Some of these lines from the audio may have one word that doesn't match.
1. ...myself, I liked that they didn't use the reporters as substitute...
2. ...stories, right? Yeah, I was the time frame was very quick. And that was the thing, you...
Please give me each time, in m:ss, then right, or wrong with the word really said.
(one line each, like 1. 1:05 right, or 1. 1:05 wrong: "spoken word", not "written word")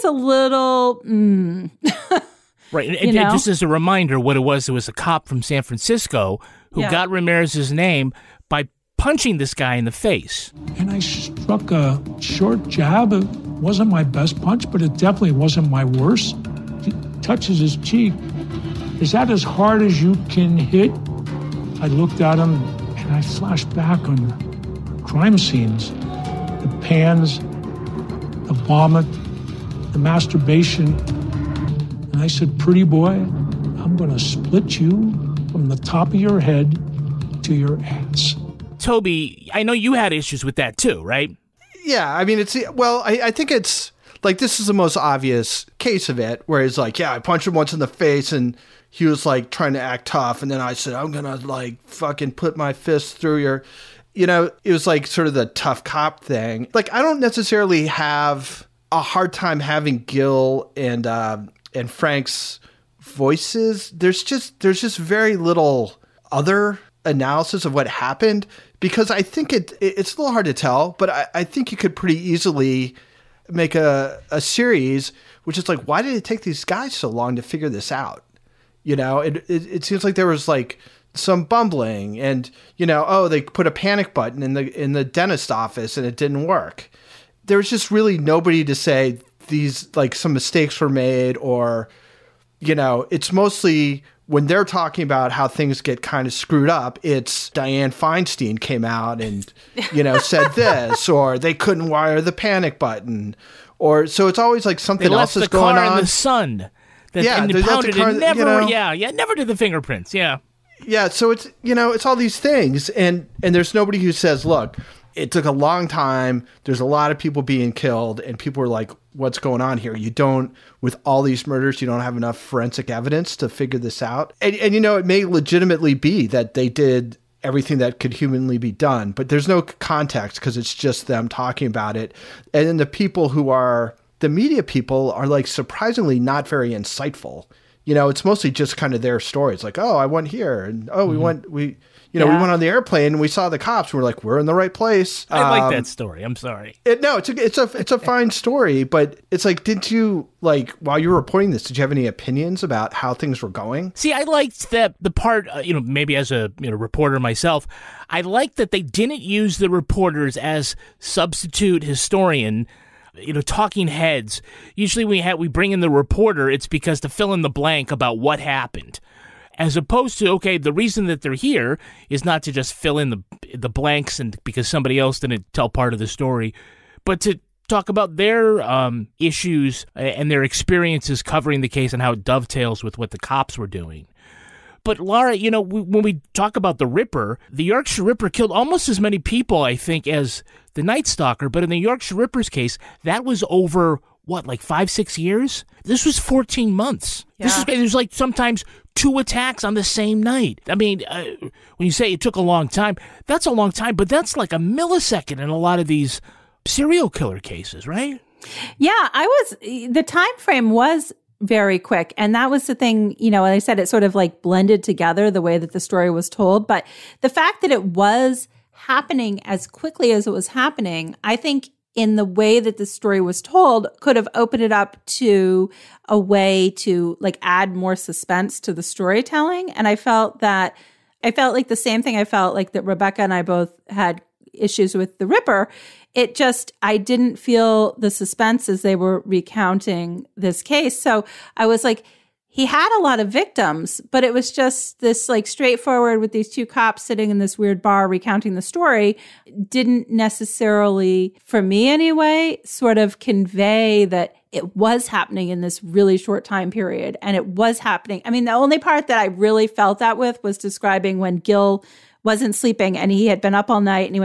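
1. 2:37 right
2. 3:27 wrong: "cases", not "stories".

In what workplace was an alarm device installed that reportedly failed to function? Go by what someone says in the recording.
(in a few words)
dentist office.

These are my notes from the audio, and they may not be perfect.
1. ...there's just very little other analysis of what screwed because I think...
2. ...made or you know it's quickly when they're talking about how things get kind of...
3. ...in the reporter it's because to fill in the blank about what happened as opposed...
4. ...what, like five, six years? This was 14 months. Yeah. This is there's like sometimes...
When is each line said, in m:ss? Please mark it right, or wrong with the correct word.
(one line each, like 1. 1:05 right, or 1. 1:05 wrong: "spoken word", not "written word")
1. 1:04 wrong: "happened", not "screwed"
2. 1:30 wrong: "mostly", not "quickly"
3. 2:45 right
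4. 3:14 right.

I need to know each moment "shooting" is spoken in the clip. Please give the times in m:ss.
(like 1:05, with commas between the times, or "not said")
not said.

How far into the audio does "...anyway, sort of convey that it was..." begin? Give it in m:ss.
4:11.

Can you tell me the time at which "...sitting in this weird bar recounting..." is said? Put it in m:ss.
4:07.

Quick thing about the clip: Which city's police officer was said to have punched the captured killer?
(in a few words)
San Francisco.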